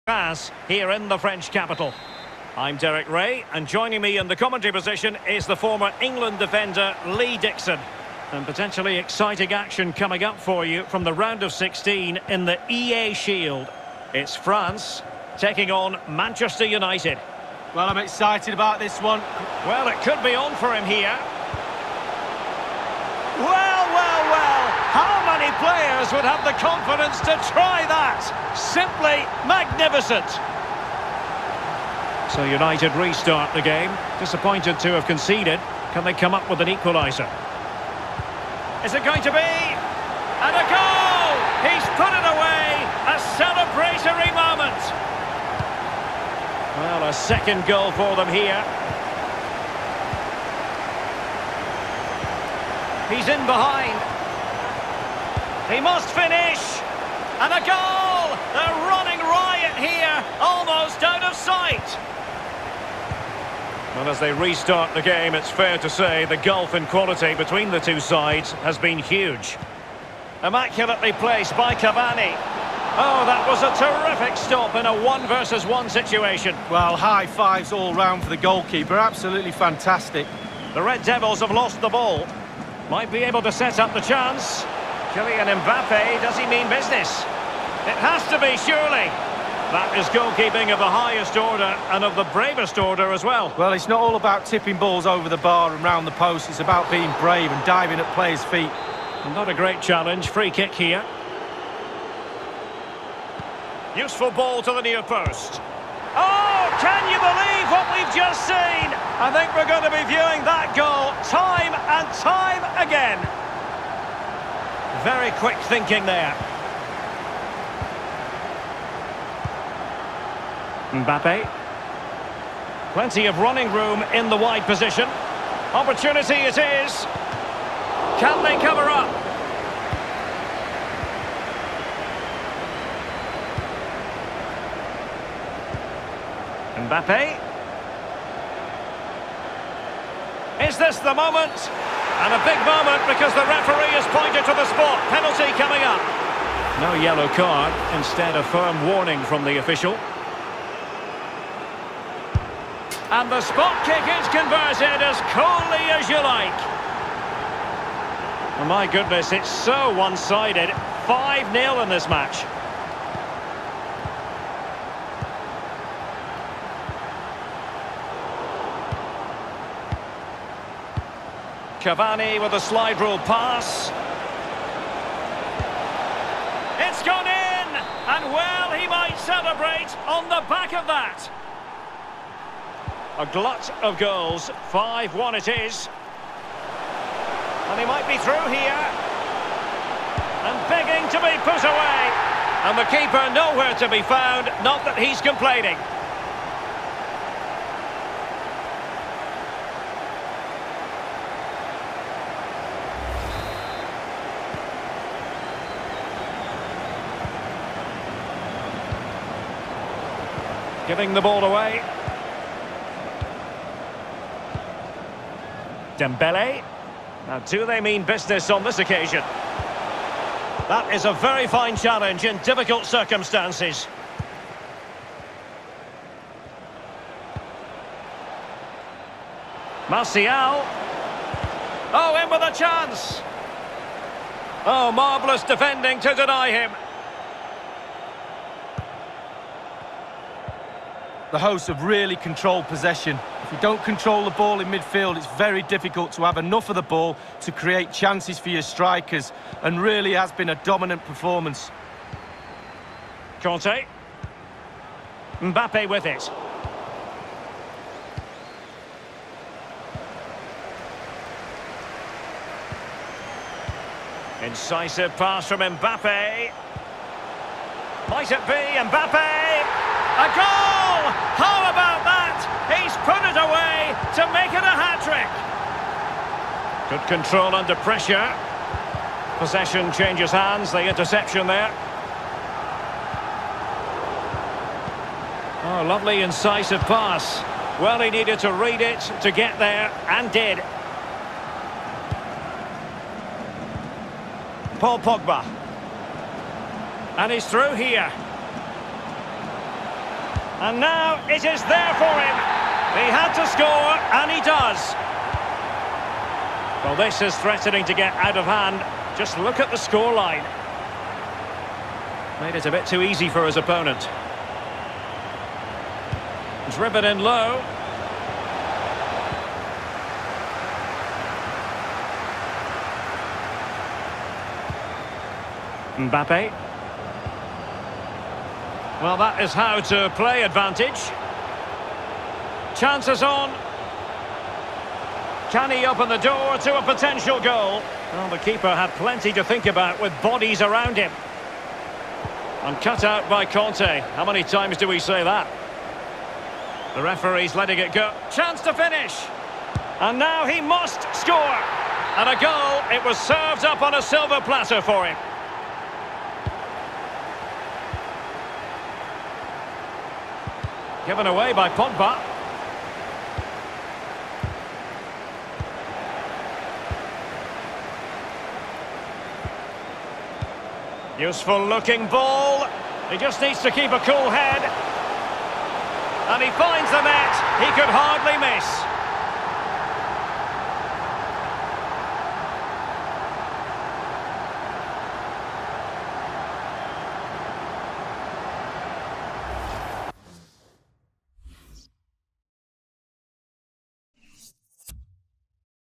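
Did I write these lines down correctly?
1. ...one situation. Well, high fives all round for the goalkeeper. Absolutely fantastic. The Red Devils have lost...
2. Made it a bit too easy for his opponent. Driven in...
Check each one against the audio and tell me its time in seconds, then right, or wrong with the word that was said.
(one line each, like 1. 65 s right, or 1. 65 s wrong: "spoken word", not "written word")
1. 75 s right
2. 312 s right.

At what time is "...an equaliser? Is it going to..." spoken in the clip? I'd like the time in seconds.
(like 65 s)
36 s.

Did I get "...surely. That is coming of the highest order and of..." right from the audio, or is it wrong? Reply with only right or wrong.
wrong.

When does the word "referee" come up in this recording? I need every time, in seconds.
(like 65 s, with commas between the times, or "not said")
143 s, 347 s.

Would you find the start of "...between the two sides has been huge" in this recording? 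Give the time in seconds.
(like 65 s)
67 s.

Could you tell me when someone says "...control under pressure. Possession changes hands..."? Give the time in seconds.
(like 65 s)
277 s.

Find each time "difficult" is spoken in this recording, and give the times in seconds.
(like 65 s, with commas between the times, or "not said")
222 s, 245 s.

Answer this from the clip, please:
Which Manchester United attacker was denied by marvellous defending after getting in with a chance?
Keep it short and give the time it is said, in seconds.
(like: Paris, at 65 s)
Martial, at 229 s.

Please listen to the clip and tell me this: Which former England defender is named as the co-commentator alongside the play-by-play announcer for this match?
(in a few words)
Lee Dixon.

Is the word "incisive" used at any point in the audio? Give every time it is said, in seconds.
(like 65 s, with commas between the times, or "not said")
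264 s, 286 s.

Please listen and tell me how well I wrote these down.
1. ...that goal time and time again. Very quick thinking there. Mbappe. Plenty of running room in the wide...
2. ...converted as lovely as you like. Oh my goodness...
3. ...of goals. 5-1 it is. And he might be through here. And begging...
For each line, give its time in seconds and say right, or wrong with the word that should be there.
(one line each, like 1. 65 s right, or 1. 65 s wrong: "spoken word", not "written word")
1. 110 s right
2. 154 s wrong: "coolly", not "lovely"
3. 183 s right.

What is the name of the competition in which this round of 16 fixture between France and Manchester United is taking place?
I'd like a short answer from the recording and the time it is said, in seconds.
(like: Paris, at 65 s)
EA Shield, at 12 s.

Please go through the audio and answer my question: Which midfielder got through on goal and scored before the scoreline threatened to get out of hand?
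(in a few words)
Paul Pogba.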